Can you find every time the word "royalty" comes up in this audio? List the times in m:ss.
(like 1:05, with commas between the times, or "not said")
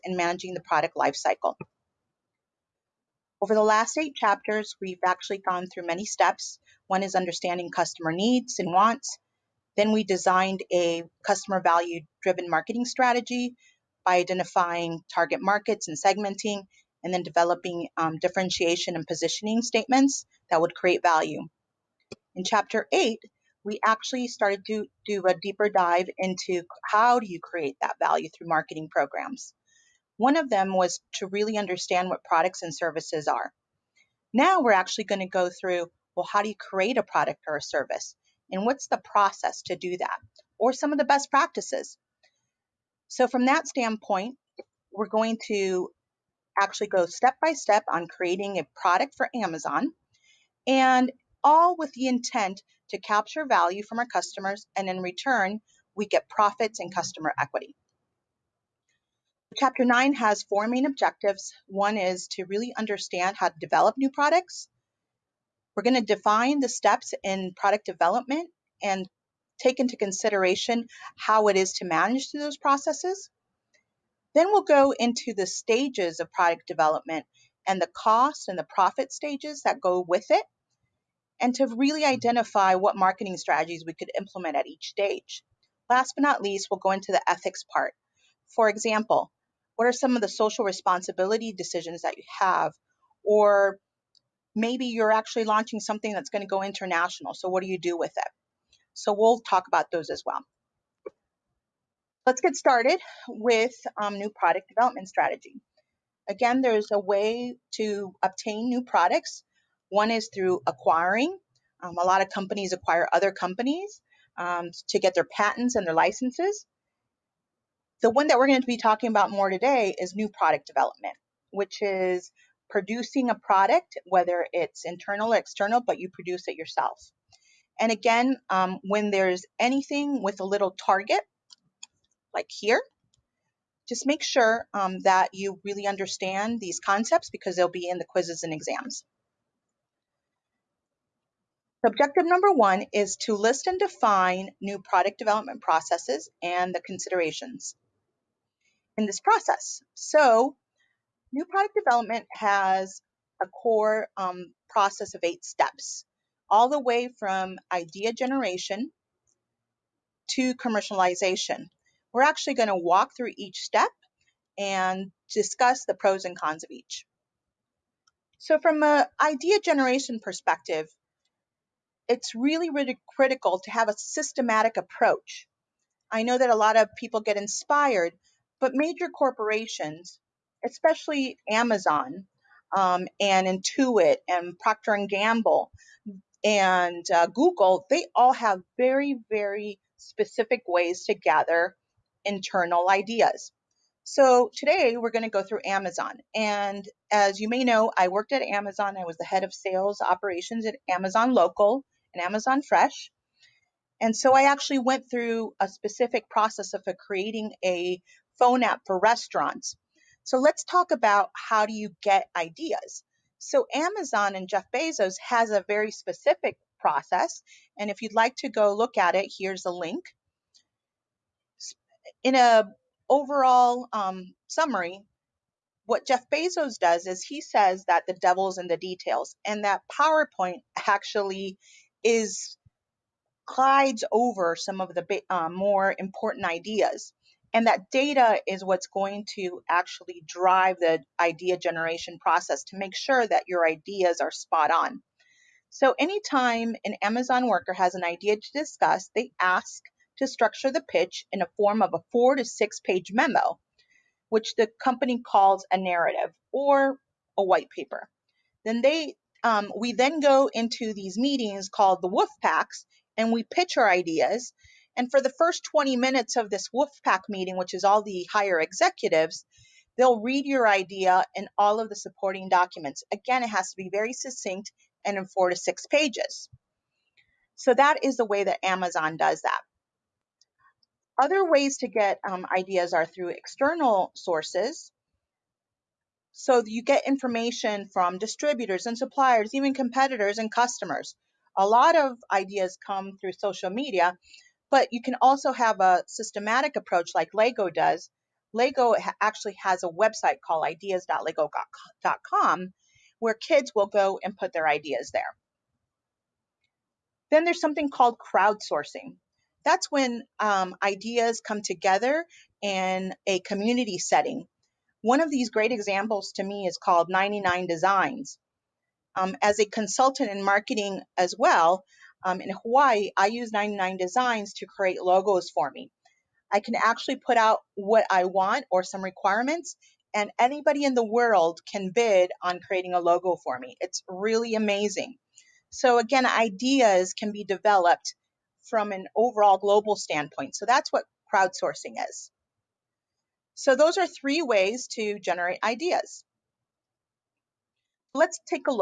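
not said.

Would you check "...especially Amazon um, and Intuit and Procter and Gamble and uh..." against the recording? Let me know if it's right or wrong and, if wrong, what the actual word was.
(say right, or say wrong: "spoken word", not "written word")
right.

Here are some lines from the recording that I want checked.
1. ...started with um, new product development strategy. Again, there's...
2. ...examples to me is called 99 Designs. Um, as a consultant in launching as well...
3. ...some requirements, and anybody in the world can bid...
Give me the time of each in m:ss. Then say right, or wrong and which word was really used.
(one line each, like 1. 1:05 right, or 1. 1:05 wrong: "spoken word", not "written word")
1. 1:42 right
2. 5:15 wrong: "marketing", not "launching"
3. 5:28 right.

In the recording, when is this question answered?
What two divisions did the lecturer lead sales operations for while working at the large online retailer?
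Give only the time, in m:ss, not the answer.
3:20.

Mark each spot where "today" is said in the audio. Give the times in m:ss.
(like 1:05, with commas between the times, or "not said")
1:59, 3:14.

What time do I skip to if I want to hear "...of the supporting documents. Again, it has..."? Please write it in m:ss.
4:31.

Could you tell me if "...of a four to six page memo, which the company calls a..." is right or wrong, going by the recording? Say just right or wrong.
right.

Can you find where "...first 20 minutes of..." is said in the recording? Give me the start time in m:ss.
4:25.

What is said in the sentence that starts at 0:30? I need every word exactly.
One of them was to really understand what products and services are.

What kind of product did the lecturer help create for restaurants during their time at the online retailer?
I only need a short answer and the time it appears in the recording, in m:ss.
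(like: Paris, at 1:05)
A phone app, at 3:28.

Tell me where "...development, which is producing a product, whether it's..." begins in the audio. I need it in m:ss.
2:00.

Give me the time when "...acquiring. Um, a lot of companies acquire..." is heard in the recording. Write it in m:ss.
1:50.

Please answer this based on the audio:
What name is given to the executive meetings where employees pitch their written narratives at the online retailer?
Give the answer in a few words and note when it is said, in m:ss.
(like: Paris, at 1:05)
Wolf Packs, at 4:22.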